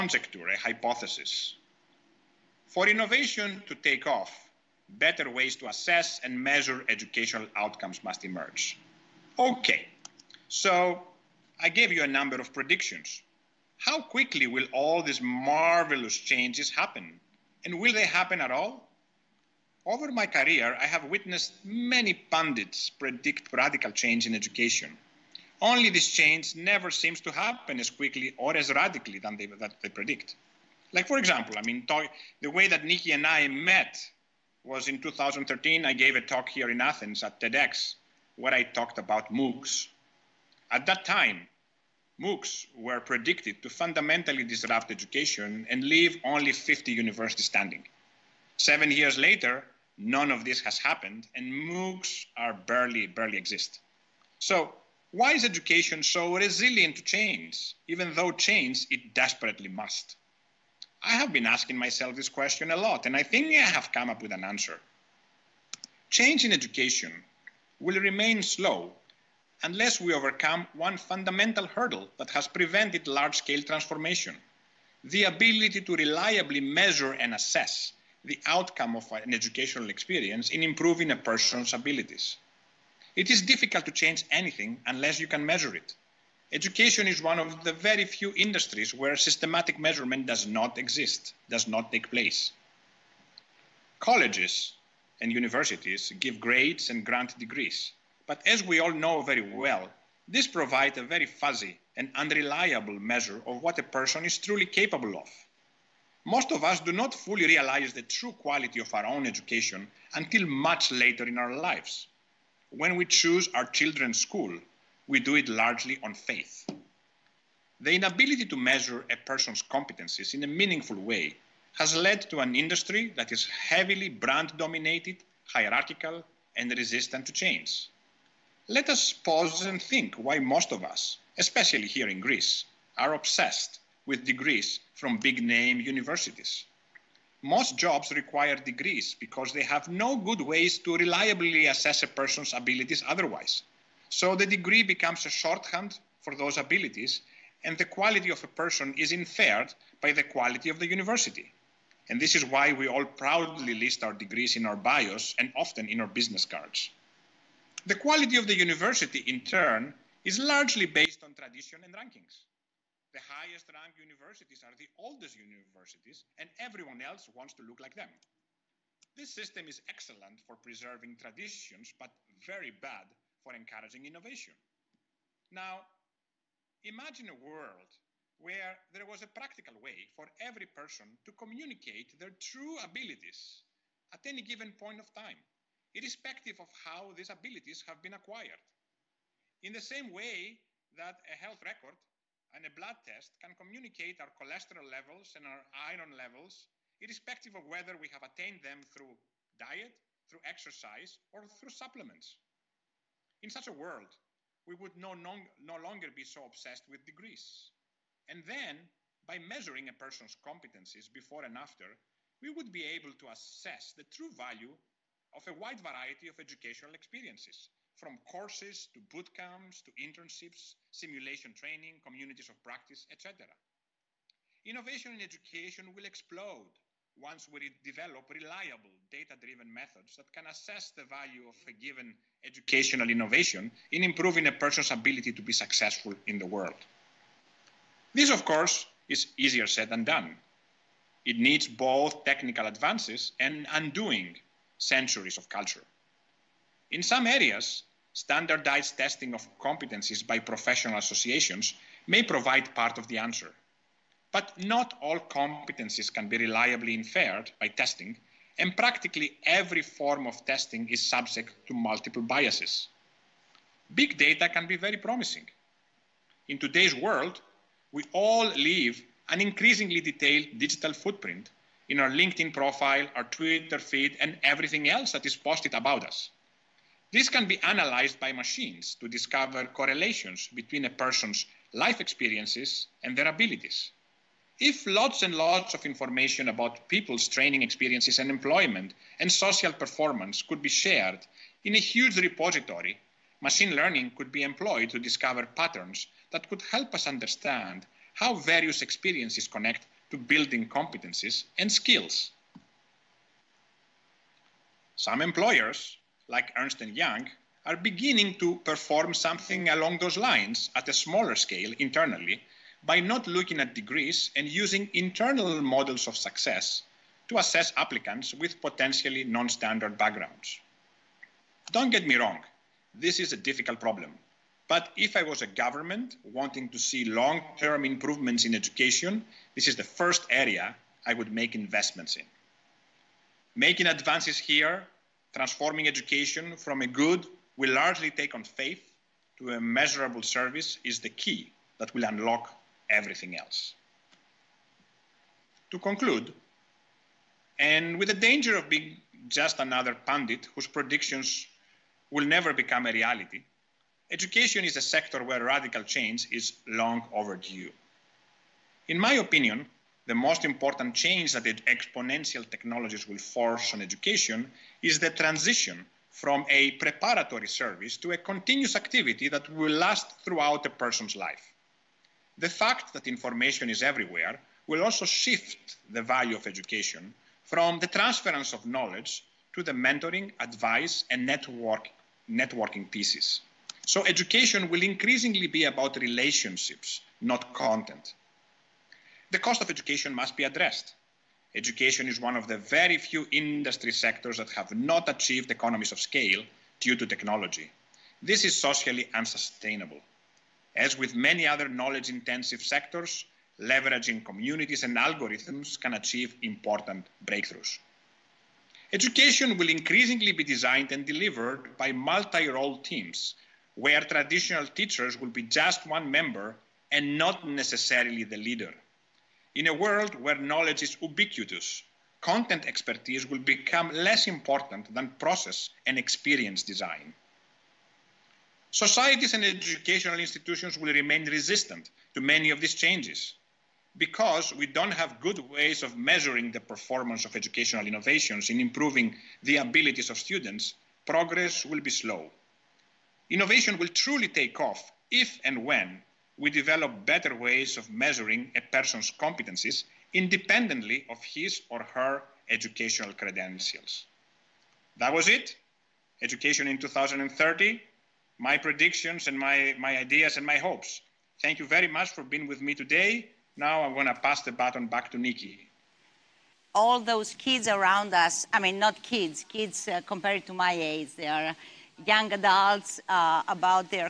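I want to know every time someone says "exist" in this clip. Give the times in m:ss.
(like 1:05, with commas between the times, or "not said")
0:53, 1:30.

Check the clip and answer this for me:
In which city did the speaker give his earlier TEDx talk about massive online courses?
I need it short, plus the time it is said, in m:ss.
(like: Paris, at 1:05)
Athens, at 0:36.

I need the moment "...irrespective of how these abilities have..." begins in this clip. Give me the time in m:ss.
3:05.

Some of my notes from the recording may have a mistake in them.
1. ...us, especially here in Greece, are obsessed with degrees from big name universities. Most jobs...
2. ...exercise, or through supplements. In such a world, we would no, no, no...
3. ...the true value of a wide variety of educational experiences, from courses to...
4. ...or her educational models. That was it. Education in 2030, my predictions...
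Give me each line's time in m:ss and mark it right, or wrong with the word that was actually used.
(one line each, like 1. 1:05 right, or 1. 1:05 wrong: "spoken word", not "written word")
1. 2:10 right
2. 3:20 right
3. 3:33 right
4. 7:31 wrong: "credentials", not "models".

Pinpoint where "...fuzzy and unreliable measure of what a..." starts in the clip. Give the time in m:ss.
1:41.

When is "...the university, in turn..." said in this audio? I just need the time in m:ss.
2:38.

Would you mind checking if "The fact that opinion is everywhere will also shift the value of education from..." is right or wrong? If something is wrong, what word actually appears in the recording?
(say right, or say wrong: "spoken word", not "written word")
wrong: "information", not "opinion".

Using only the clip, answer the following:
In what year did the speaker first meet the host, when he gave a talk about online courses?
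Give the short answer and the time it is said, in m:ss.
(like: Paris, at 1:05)
2013, at 0:35.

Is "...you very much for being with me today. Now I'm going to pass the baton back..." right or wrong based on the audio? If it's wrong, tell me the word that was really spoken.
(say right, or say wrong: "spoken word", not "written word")
right.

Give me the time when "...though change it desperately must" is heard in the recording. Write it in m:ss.
0:58.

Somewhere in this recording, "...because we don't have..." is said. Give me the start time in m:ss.
7:13.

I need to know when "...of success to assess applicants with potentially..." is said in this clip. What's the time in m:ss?
5:16.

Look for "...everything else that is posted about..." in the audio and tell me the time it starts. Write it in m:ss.
4:34.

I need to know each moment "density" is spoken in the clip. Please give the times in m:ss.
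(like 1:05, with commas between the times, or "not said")
not said.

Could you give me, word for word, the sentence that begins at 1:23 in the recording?
It is difficult to change anything unless you can measure it.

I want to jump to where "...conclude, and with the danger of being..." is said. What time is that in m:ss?
5:45.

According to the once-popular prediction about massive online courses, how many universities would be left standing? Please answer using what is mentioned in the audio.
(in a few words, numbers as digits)
50.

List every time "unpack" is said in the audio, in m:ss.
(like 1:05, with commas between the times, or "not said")
not said.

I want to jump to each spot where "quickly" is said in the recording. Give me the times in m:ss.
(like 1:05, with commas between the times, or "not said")
0:14, 0:27.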